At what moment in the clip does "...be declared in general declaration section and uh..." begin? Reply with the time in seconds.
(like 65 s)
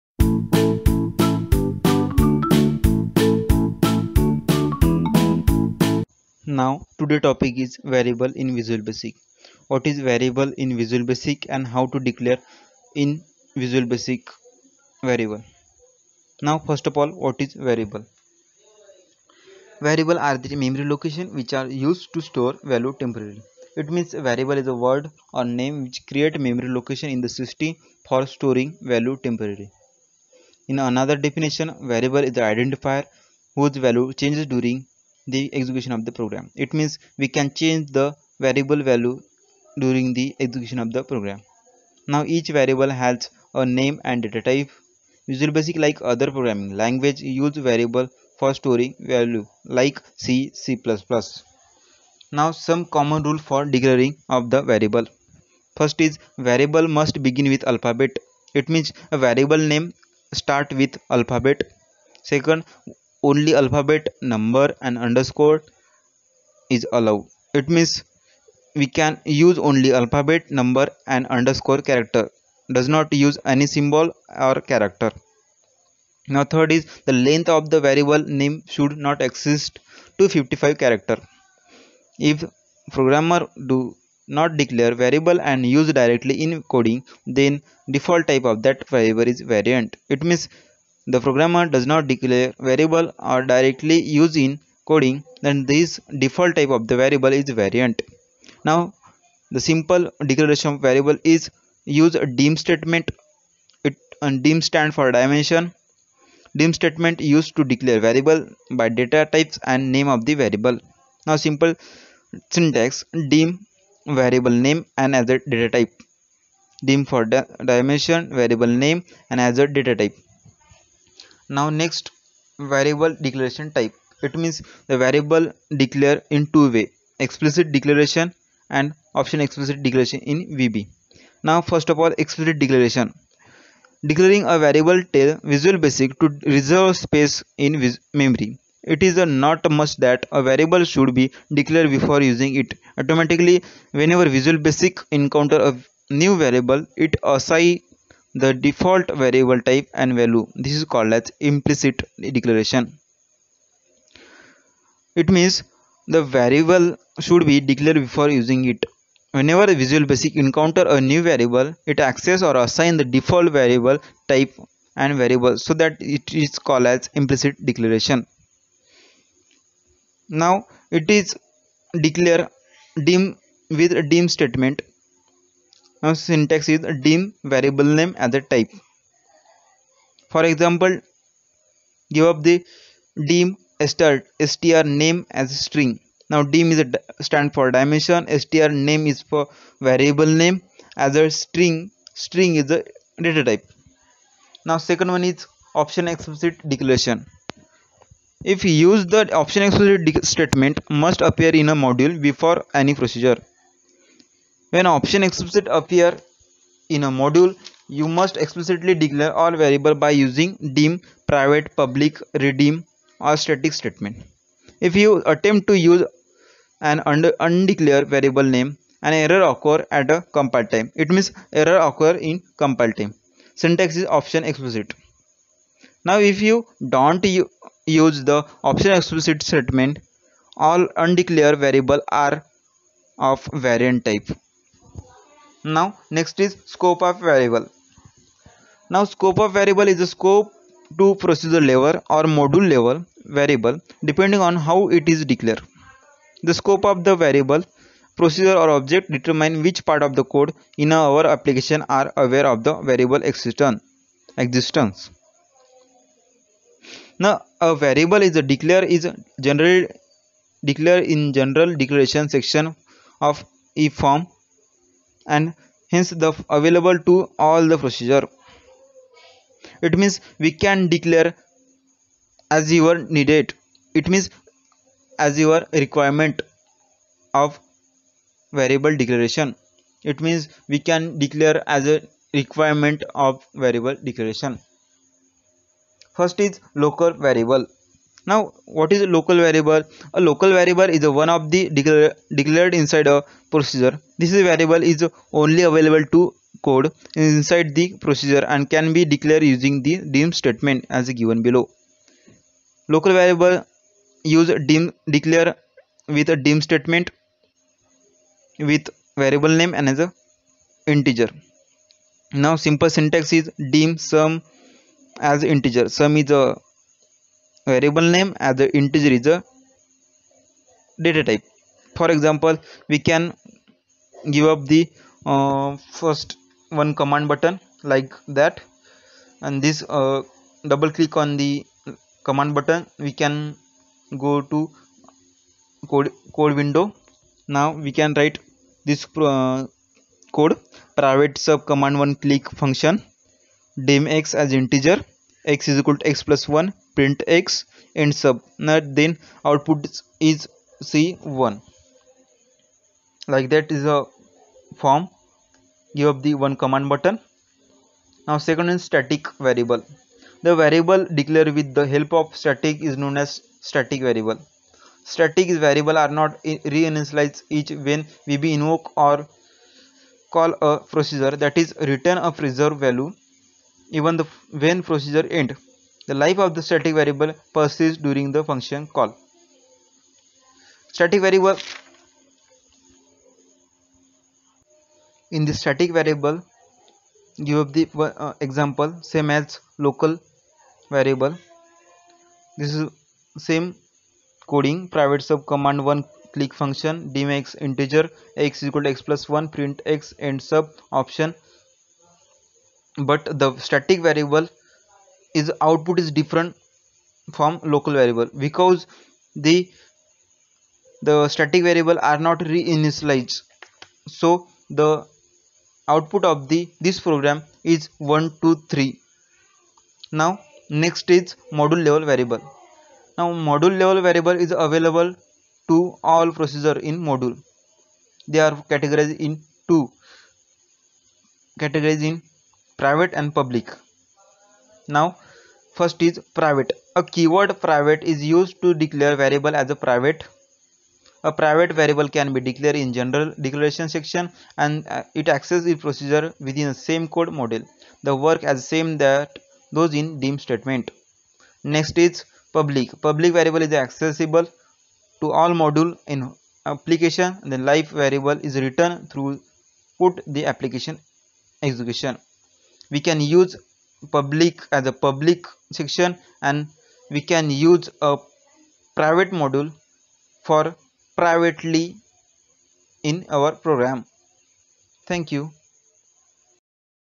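442 s.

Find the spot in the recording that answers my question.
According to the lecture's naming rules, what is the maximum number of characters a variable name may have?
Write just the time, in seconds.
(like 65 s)
80 s.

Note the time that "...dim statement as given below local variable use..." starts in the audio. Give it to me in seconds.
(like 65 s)
300 s.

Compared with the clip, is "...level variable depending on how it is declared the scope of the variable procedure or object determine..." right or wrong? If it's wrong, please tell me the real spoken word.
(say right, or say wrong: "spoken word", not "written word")
right.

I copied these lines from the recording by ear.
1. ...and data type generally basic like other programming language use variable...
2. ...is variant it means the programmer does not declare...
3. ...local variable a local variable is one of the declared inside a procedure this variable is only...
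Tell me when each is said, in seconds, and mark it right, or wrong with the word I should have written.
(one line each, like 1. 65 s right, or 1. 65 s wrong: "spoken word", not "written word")
1. 44 s wrong: "usually", not "generally"
2. 89 s right
3. 289 s right.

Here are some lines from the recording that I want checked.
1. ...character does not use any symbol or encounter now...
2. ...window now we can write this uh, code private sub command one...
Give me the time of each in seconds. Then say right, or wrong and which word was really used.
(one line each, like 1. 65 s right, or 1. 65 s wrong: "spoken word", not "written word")
1. 71 s wrong: "character", not "encounter"
2. 336 s right.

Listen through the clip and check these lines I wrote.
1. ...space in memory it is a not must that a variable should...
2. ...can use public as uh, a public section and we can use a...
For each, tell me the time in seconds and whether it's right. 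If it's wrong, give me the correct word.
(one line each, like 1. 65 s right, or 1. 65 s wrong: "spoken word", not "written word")
1. 137 s right
2. 463 s right.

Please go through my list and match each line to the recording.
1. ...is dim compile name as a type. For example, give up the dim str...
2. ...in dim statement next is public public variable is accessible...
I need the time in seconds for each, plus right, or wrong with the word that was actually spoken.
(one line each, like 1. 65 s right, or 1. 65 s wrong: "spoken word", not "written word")
1. 176 s wrong: "variable", not "compile"
2. 449 s right.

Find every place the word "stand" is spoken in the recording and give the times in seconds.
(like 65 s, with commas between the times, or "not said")
104 s, 187 s.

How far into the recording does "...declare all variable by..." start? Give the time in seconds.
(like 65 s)
208 s.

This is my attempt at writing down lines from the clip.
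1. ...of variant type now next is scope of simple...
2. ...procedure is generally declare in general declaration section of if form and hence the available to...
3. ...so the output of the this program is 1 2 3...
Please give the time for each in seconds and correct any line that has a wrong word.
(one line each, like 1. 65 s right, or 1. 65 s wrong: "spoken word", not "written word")
1. 233 s wrong: "variable", not "simple"
2. 258 s wrong: "declare", not "procedure"
3. 414 s right.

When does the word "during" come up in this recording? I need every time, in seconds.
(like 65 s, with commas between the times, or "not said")
34 s, 39 s, 378 s.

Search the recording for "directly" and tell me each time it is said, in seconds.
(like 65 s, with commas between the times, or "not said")
86 s, 93 s.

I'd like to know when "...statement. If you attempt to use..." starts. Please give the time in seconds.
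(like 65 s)
213 s.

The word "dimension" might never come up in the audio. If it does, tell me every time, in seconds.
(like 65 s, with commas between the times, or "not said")
105 s, 117 s, 187 s.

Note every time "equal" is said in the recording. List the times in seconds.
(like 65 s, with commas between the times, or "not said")
345 s, 398 s.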